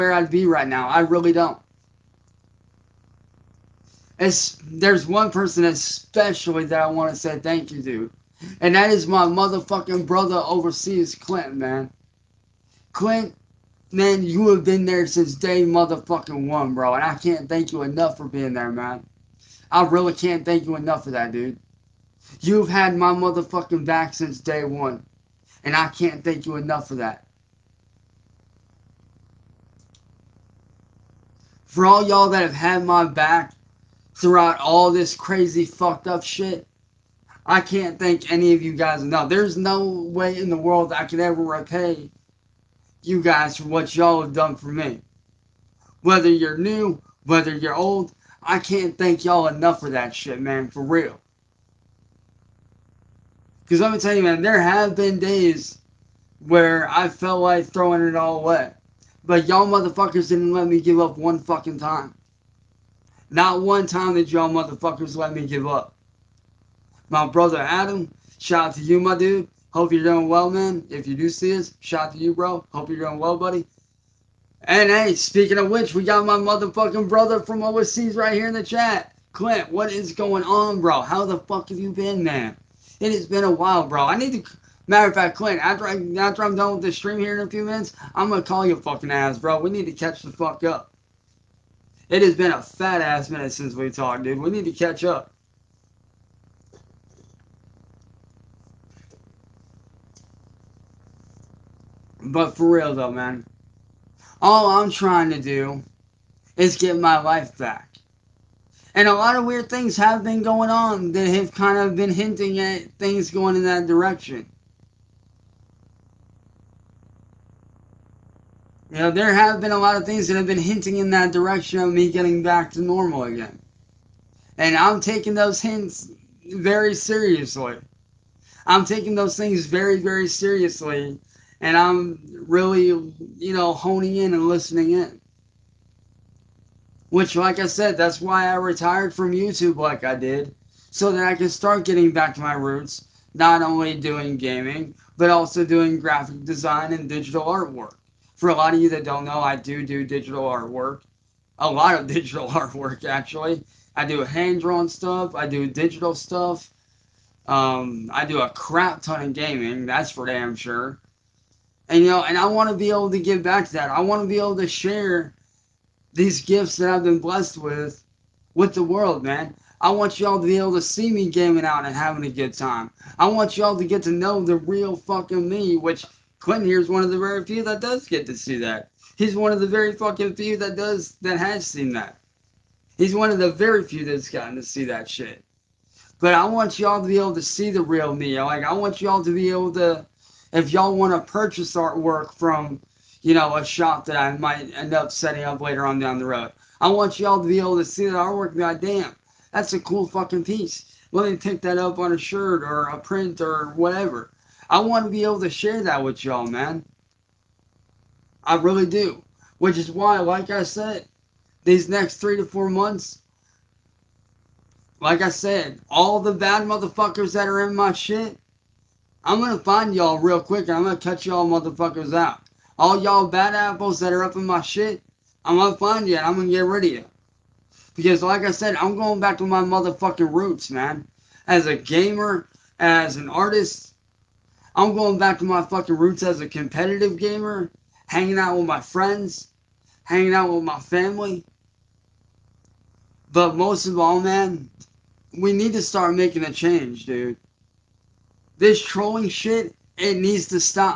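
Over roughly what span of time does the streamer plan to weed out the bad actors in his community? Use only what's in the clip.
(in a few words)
3 to 4 months.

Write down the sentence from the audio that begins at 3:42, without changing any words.
All y'all bad apples that are up in my shit, I'm gonna find you and I'm gonna get rid of you.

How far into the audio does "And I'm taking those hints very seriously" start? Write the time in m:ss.
2:04.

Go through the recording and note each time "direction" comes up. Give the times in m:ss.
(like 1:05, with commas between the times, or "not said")
1:53, 2:01.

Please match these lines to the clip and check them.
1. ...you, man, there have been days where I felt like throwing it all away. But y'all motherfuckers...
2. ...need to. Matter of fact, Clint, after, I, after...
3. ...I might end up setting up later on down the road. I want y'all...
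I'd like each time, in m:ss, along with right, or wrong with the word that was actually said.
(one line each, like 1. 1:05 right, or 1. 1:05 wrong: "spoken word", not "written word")
1. 0:54 right
2. 1:24 right
3. 3:14 right.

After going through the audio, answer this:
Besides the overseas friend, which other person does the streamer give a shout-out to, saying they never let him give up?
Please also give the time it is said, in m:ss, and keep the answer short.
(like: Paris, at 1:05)
Adam, at 1:07.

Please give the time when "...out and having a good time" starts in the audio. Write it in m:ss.
2:51.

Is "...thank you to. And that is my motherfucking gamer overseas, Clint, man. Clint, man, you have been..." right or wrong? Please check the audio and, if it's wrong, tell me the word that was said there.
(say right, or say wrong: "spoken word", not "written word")
wrong: "brother", not "gamer".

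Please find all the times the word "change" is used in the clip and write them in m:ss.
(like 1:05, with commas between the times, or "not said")
4:06.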